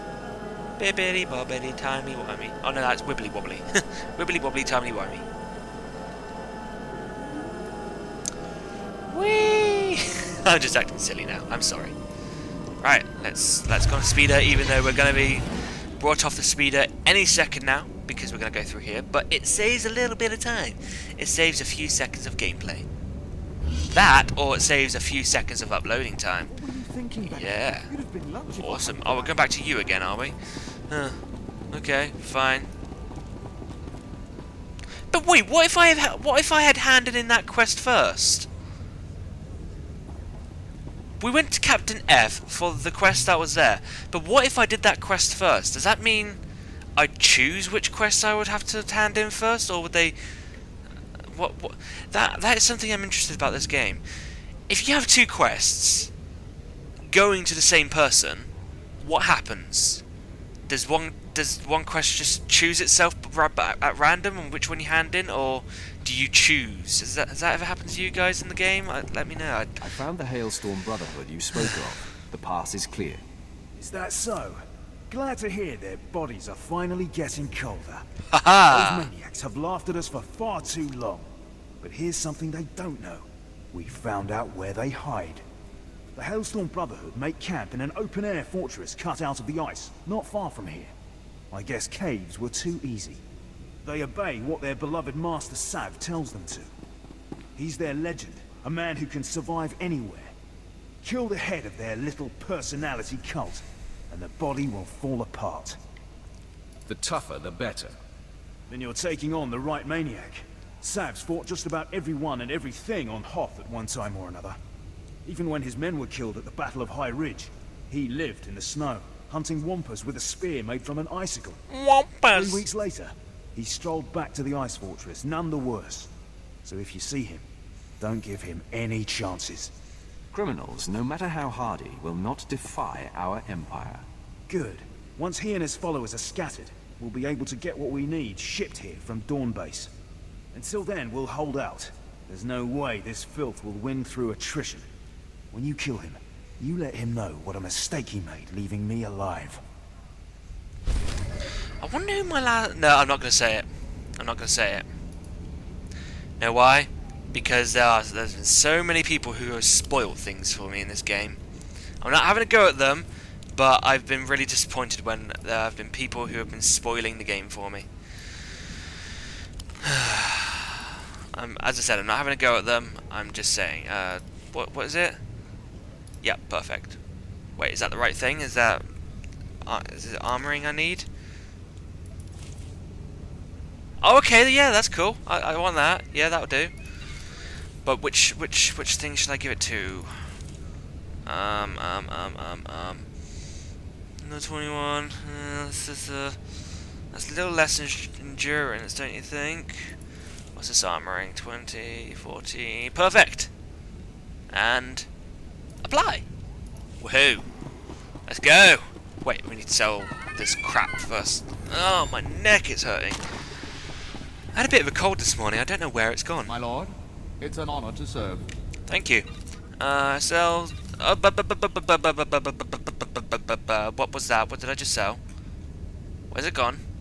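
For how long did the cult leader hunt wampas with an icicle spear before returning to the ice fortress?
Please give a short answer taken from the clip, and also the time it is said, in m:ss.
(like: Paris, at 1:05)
Three weeks, at 2:02.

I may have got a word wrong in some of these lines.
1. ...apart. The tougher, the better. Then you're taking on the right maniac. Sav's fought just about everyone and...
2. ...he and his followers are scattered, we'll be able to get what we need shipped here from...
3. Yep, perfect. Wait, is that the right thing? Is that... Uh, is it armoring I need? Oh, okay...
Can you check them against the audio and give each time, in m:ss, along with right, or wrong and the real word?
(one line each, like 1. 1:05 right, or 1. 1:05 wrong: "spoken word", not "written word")
1. 1:45 right
2. 2:15 right
3. 2:56 right.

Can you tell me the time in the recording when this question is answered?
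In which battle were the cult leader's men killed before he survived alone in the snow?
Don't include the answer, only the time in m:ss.
1:56.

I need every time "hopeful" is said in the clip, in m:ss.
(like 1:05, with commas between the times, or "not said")
not said.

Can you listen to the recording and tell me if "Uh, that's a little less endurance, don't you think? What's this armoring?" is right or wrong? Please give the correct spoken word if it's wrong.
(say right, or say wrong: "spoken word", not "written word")
right.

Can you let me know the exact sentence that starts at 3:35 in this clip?
I don't know where it's gone.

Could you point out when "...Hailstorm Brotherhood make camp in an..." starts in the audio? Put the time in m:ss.
1:26.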